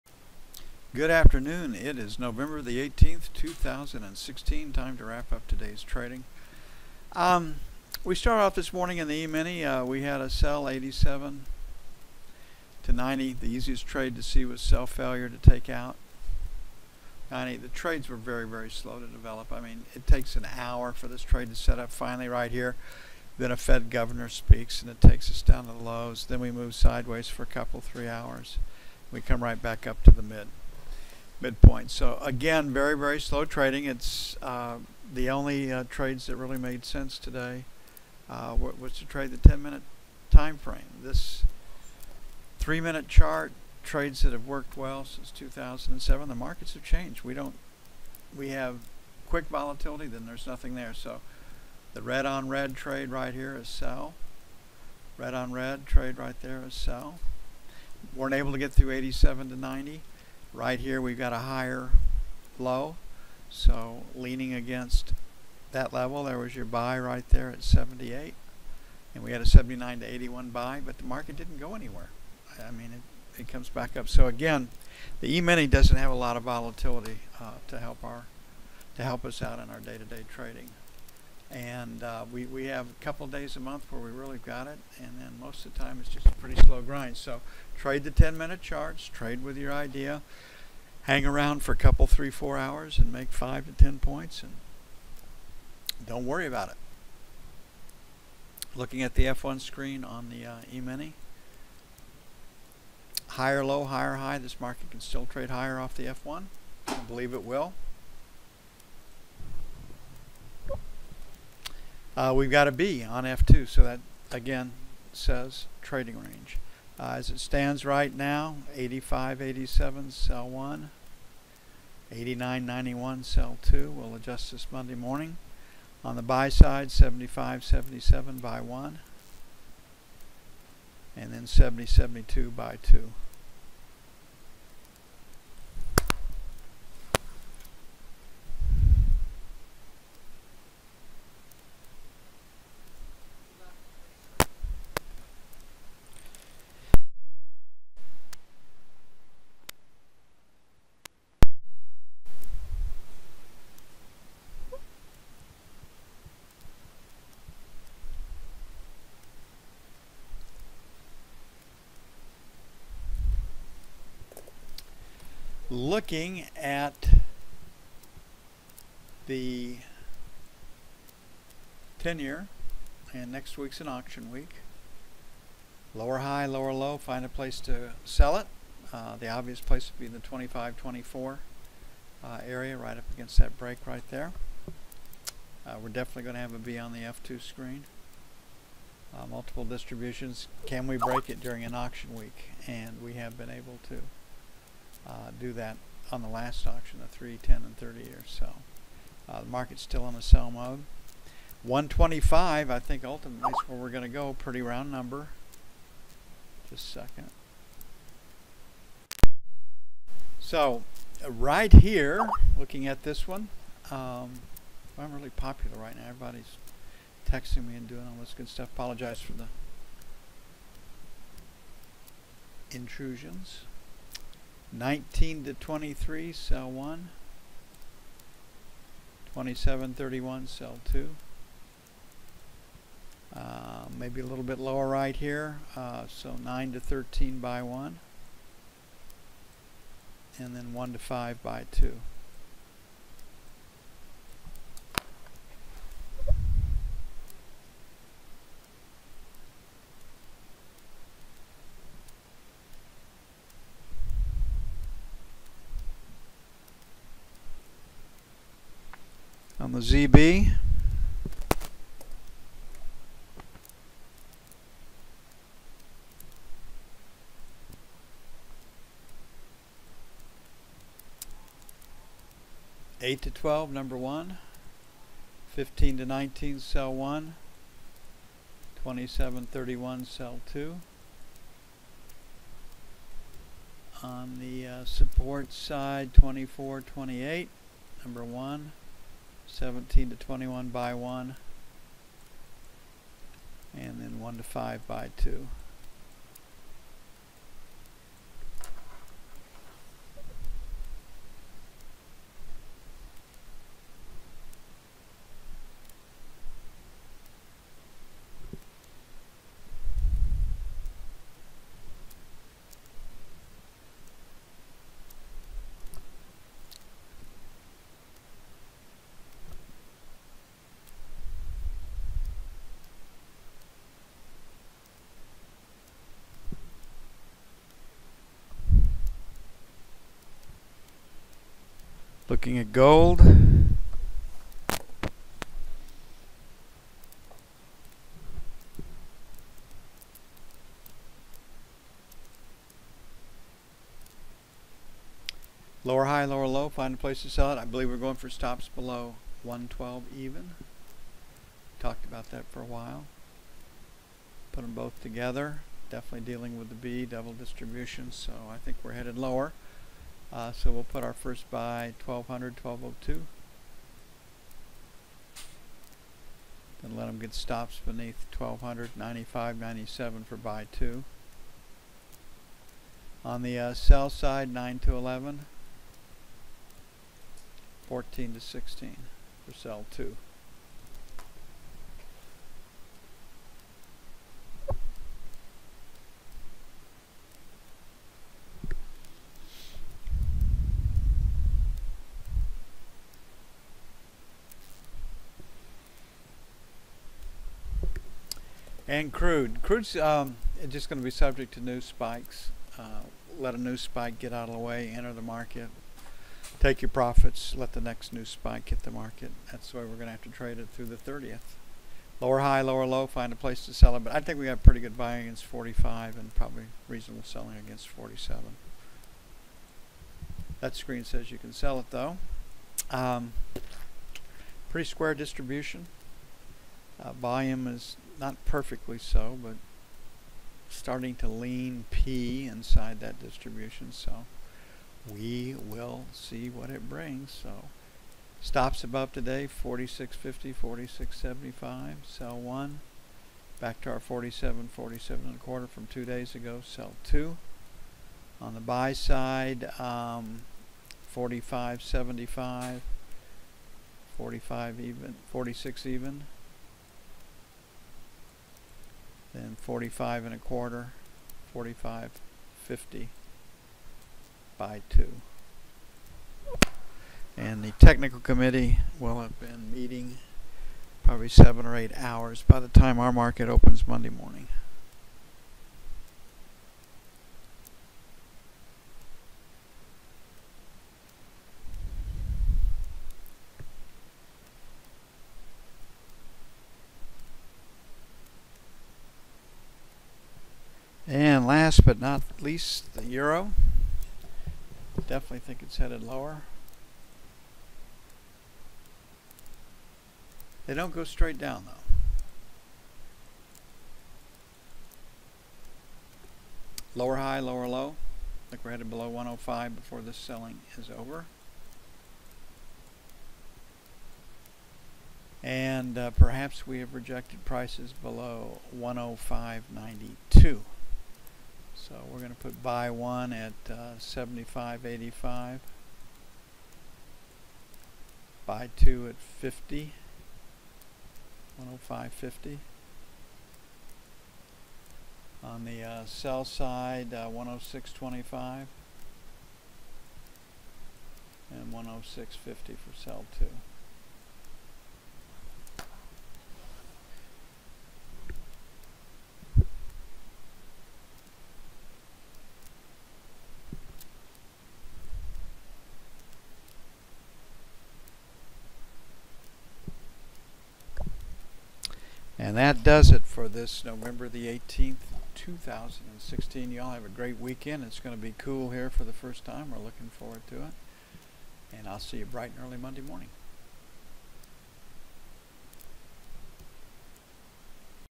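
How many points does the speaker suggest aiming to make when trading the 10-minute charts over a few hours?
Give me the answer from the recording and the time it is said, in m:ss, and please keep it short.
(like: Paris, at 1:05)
5 to 10, at 1:33.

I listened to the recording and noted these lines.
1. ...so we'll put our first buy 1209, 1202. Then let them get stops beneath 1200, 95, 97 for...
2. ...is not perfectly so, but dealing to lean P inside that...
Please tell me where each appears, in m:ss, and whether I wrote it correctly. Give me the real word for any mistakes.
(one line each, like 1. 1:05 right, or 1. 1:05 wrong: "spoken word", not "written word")
1. 6:00 wrong: "1200", not "1209"
2. 7:07 wrong: "starting", not "dealing".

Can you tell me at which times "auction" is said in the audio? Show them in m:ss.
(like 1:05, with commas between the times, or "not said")
2:53, 3:11, 3:16.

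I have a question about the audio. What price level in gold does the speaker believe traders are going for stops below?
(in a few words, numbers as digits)
112.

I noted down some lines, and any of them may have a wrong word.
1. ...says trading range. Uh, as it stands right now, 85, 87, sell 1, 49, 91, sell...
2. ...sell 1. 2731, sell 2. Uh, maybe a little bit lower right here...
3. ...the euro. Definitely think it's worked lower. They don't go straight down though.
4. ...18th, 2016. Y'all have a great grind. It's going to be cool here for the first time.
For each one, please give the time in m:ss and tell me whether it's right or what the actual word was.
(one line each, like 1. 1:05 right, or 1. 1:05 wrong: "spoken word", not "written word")
1. 1:55 wrong: "89", not "49"
2. 3:46 right
3. 8:12 wrong: "headed", not "worked"
4. 9:24 wrong: "weekend", not "grind".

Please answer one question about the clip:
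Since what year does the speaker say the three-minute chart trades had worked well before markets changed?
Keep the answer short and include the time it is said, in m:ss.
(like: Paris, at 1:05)
2007, at 0:45.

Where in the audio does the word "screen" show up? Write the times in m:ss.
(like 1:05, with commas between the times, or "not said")
1:39, 3:07, 7:00.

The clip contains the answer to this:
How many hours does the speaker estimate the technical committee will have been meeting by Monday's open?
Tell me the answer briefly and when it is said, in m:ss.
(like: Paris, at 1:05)
7 or 8, at 7:51.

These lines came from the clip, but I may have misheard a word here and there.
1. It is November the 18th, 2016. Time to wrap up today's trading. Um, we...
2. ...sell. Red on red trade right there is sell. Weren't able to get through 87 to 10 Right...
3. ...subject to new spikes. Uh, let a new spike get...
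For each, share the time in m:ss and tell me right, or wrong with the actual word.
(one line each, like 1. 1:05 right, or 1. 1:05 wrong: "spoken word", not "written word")
1. 0:01 right
2. 0:53 wrong: "90", not "10"
3. 6:41 right.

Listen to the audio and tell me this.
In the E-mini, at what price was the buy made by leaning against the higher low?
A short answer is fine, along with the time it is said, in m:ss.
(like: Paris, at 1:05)
78, at 1:07.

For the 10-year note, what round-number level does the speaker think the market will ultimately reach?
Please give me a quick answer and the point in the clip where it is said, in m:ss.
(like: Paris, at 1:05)
125, at 3:21.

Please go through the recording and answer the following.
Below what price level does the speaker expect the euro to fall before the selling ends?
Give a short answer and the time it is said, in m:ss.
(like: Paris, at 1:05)
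105, at 8:29.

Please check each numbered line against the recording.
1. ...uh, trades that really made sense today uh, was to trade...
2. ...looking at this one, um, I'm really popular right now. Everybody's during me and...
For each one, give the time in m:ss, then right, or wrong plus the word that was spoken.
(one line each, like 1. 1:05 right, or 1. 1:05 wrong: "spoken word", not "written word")
1. 0:35 right
2. 3:32 wrong: "texting", not "during".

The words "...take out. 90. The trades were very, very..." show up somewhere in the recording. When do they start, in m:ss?
0:15.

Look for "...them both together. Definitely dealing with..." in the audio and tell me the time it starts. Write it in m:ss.
5:54.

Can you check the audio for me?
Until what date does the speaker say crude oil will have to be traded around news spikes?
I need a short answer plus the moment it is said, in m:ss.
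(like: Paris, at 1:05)
the 30th, at 6:50.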